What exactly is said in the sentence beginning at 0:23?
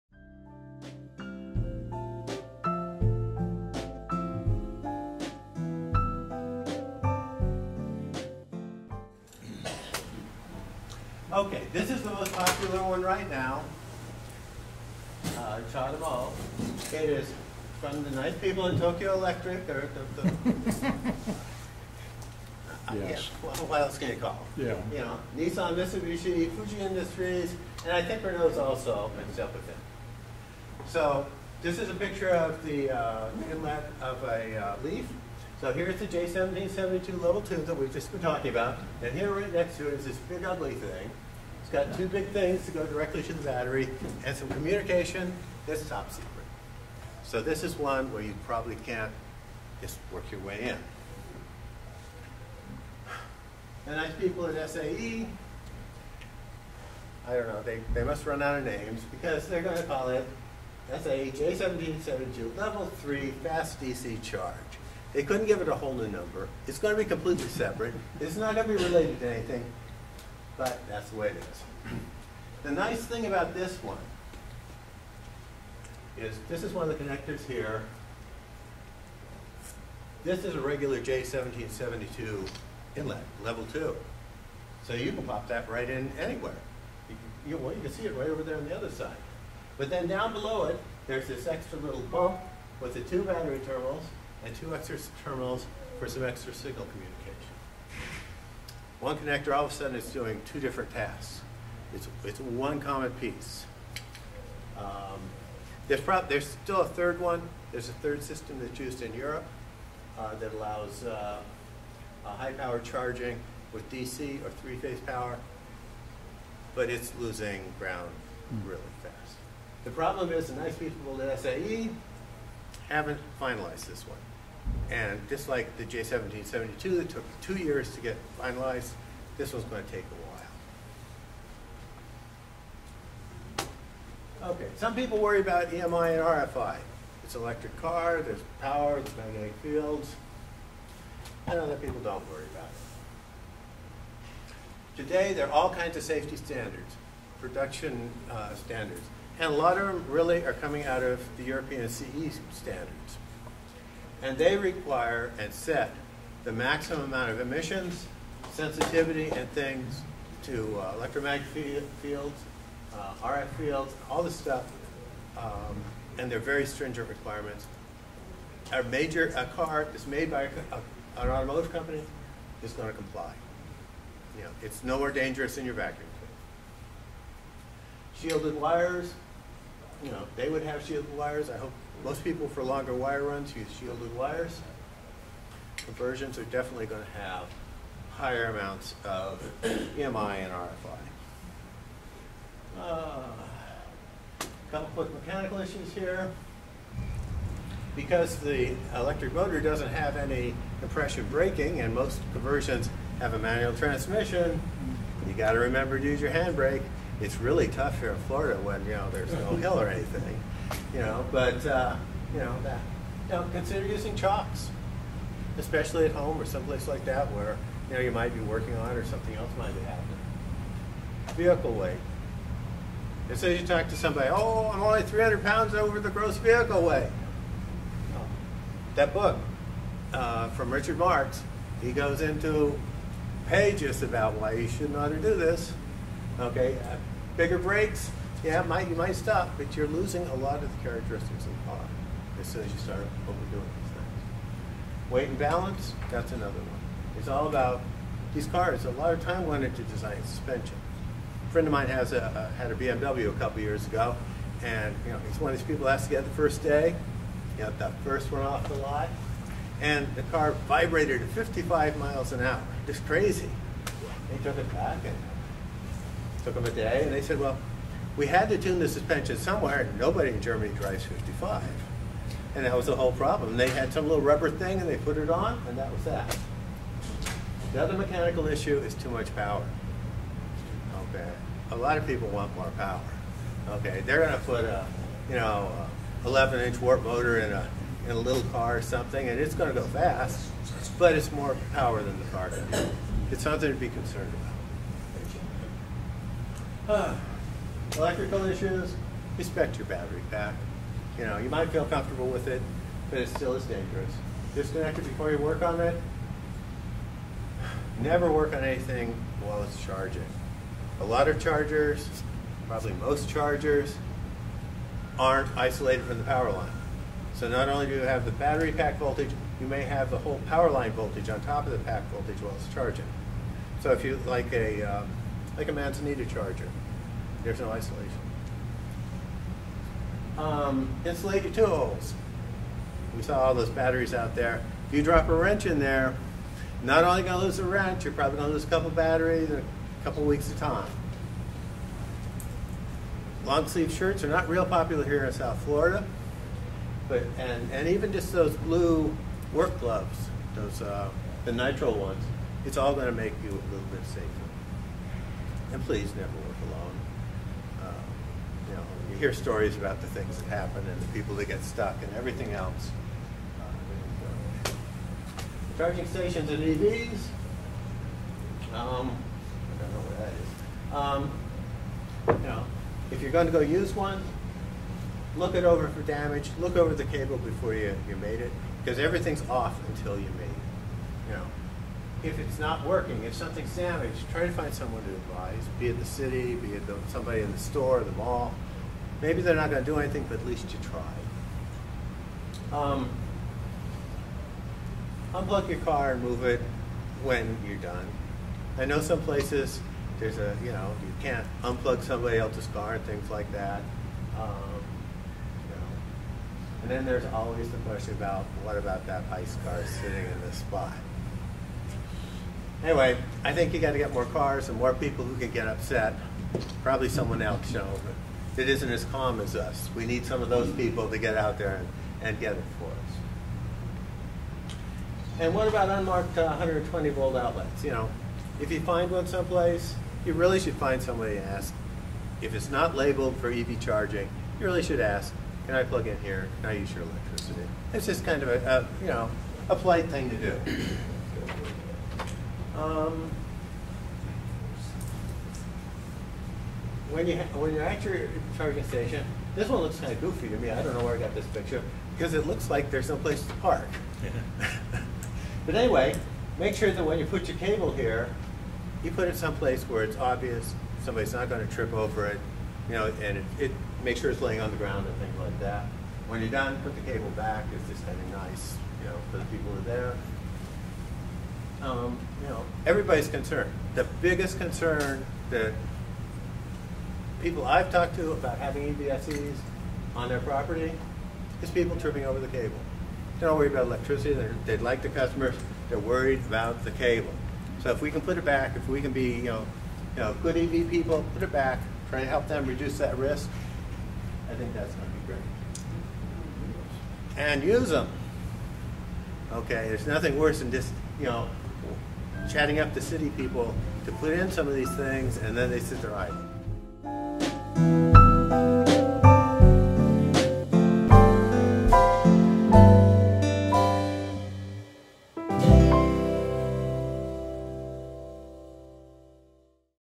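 Yeah, what else can you call?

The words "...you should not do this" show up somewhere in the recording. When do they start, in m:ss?
3:54.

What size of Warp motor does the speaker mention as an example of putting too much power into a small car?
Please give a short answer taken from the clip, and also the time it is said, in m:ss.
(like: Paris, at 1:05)
11-inch, at 4:46.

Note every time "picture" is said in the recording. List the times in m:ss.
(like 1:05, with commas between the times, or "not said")
0:31, 7:31.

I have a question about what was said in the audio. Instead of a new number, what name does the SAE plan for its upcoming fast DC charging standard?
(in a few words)
SAE J1772 level 3 fast DC charge.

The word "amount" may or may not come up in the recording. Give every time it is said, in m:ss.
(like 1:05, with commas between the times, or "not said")
2:37, 3:08.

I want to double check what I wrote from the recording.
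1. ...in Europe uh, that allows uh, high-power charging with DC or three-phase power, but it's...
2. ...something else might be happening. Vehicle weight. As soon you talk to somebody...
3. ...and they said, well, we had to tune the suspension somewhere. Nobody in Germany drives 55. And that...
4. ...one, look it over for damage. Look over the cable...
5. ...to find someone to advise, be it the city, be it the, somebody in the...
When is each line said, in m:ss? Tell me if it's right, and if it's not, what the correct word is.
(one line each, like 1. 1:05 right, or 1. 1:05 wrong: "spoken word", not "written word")
1. 1:49 right
2. 3:39 right
3. 4:27 right
4. 6:13 right
5. 6:24 right.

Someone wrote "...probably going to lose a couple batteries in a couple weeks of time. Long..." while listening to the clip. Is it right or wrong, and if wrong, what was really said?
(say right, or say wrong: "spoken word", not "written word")
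right.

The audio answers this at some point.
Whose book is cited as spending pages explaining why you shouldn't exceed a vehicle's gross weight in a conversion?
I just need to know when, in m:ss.
3:50.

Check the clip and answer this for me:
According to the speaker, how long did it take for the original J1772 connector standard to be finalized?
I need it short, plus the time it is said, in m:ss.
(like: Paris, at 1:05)
two years, at 2:07.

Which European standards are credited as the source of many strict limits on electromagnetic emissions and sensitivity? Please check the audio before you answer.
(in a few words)
CE standards.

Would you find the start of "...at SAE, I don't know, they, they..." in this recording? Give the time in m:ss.
0:54.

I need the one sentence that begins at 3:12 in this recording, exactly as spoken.
Uh, couple quick mechanical issues here.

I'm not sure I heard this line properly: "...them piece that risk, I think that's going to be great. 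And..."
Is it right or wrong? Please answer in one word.
wrong.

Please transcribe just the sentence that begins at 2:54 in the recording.
You know, it's more dangerous than your vacuum.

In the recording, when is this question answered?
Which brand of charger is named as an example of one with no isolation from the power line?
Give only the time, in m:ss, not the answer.
5:25.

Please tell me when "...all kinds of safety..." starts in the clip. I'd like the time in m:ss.
2:25.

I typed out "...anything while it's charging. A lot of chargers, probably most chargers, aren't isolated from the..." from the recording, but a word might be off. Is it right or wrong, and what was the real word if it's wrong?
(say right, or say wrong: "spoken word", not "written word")
right.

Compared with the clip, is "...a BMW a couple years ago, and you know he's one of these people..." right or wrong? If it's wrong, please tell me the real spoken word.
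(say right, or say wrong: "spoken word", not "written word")
right.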